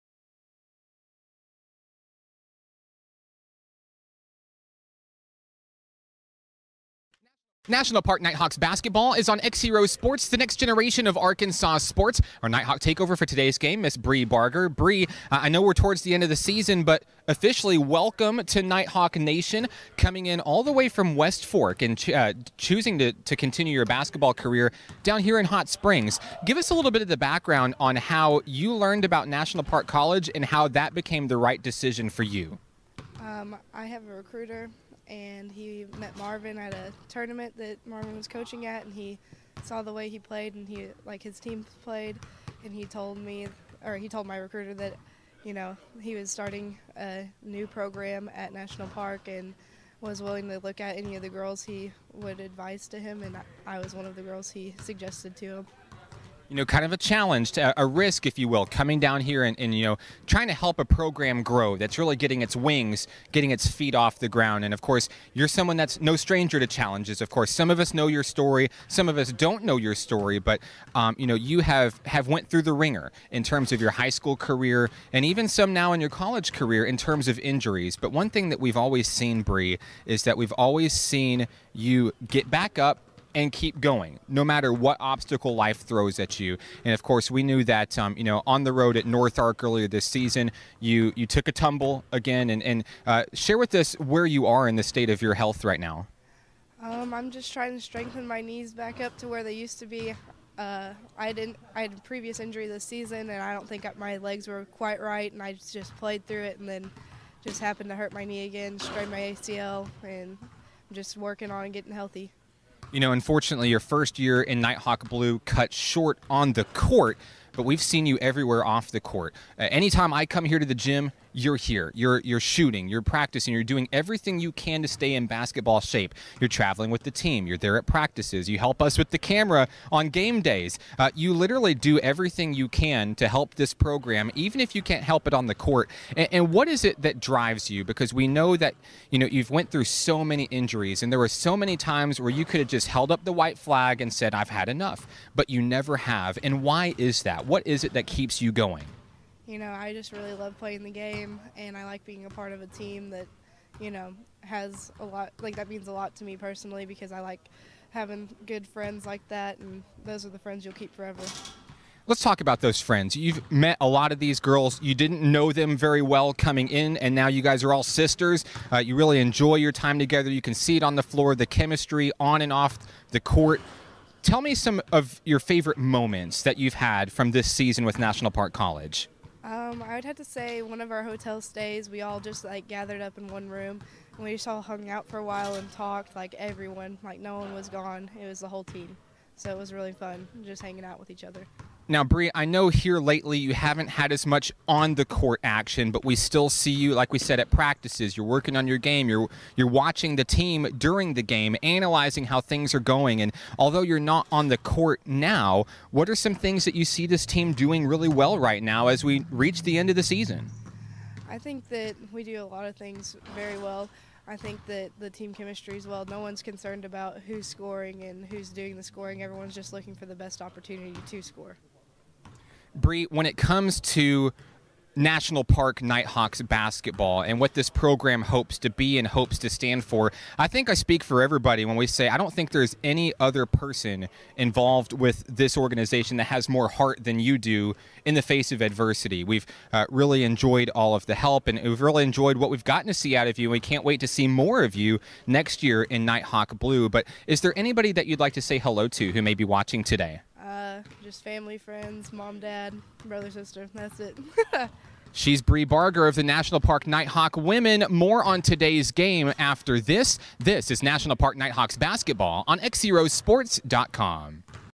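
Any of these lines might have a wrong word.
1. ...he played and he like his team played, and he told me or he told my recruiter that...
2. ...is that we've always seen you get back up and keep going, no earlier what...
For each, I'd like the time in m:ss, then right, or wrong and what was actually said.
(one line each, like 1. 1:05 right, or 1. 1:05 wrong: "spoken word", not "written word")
1. 0:40 right
2. 1:20 wrong: "matter", not "earlier".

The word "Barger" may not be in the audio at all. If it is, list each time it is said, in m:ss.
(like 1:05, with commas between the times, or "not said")
0:14, 4:15.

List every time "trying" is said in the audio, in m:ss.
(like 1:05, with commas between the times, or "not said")
1:00, 1:37.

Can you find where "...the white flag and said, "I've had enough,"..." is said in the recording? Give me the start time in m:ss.
2:23.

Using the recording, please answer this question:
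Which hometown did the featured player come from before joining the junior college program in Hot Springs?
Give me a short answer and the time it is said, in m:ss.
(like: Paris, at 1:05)
West Fork, at 0:21.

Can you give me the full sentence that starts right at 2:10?
Uh, you literally do everything you can to help this program, even if you can't help it on the court.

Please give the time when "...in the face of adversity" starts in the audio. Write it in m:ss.
3:58.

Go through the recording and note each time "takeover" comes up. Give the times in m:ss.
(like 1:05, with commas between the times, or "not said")
0:12.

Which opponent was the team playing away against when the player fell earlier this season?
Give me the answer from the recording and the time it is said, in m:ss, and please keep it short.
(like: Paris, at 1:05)
NorthArk, at 1:29.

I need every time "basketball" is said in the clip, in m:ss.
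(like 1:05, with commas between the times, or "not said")
0:08, 0:23, 2:05, 3:46, 4:21.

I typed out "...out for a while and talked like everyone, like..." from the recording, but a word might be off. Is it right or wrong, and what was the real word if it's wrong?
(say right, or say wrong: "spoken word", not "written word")
right.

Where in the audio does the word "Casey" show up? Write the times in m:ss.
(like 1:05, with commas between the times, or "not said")
not said.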